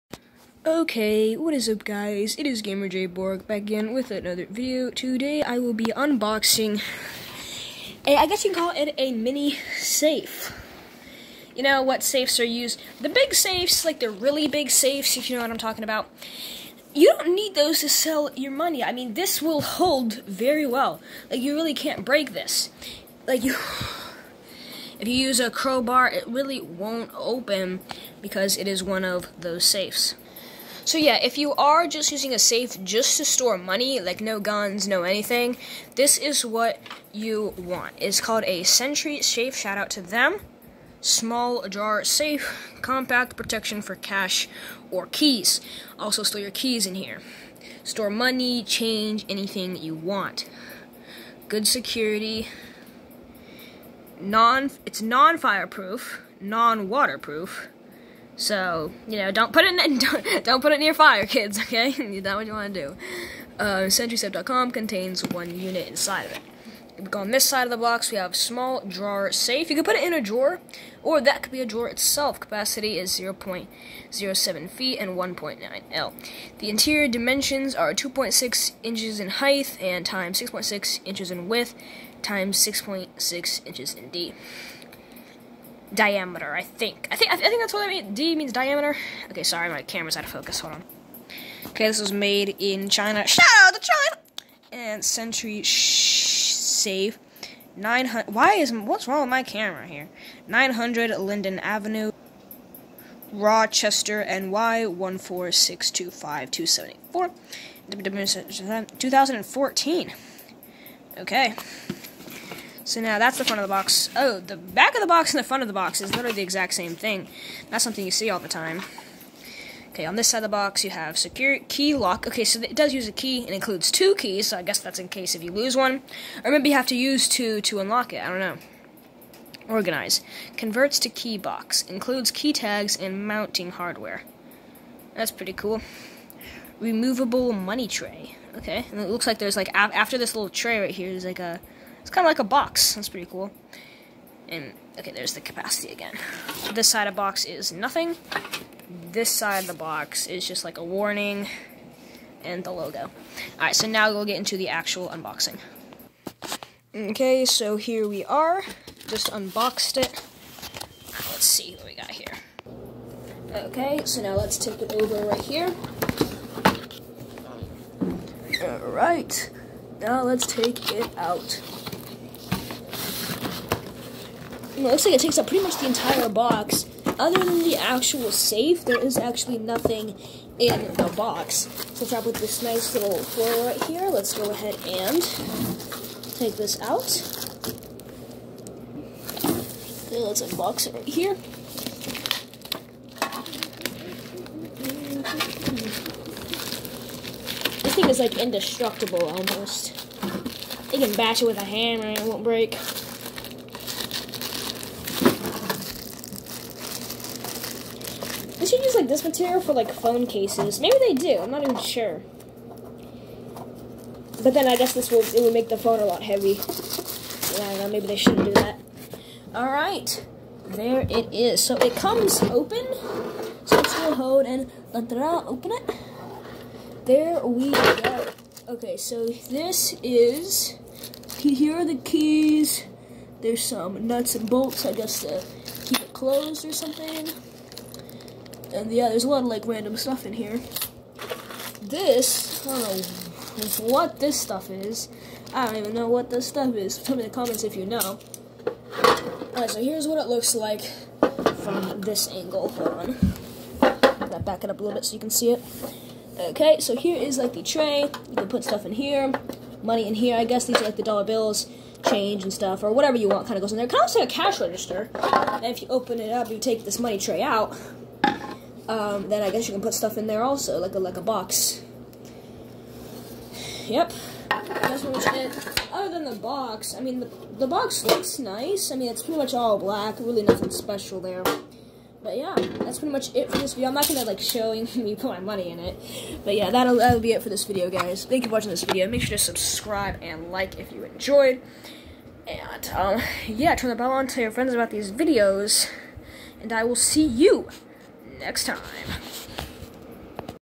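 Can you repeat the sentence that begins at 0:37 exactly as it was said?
It's called a Sentry Safe, shout out to them.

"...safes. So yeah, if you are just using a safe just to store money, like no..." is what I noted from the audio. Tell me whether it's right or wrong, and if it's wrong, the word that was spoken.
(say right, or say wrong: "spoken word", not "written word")
right.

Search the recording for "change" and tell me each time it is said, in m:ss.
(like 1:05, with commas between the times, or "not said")
0:48, 4:22.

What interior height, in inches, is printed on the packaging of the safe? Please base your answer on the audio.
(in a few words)
2.6 inches.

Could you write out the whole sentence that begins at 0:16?
You don't need those to sell your money.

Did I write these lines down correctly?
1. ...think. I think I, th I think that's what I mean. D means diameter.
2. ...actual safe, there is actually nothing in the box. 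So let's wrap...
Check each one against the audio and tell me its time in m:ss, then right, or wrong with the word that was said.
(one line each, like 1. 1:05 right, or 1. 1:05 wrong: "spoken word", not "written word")
1. 1:26 right
2. 2:57 right.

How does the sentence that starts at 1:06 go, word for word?
We go on this side of the box, we have small drawer safe.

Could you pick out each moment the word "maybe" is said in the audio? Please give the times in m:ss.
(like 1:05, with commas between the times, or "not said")
2:06, 3:30, 3:37.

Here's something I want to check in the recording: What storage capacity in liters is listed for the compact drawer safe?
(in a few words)
1.9 L.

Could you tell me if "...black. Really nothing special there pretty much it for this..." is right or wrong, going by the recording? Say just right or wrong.
right.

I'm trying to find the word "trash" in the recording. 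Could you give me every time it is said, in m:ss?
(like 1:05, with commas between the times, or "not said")
not said.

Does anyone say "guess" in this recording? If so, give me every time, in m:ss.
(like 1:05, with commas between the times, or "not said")
0:08, 2:04, 3:34, 3:54, 4:20, 4:29.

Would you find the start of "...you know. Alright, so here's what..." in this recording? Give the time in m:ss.
4:07.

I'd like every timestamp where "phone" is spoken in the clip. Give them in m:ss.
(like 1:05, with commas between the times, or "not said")
3:29, 3:35.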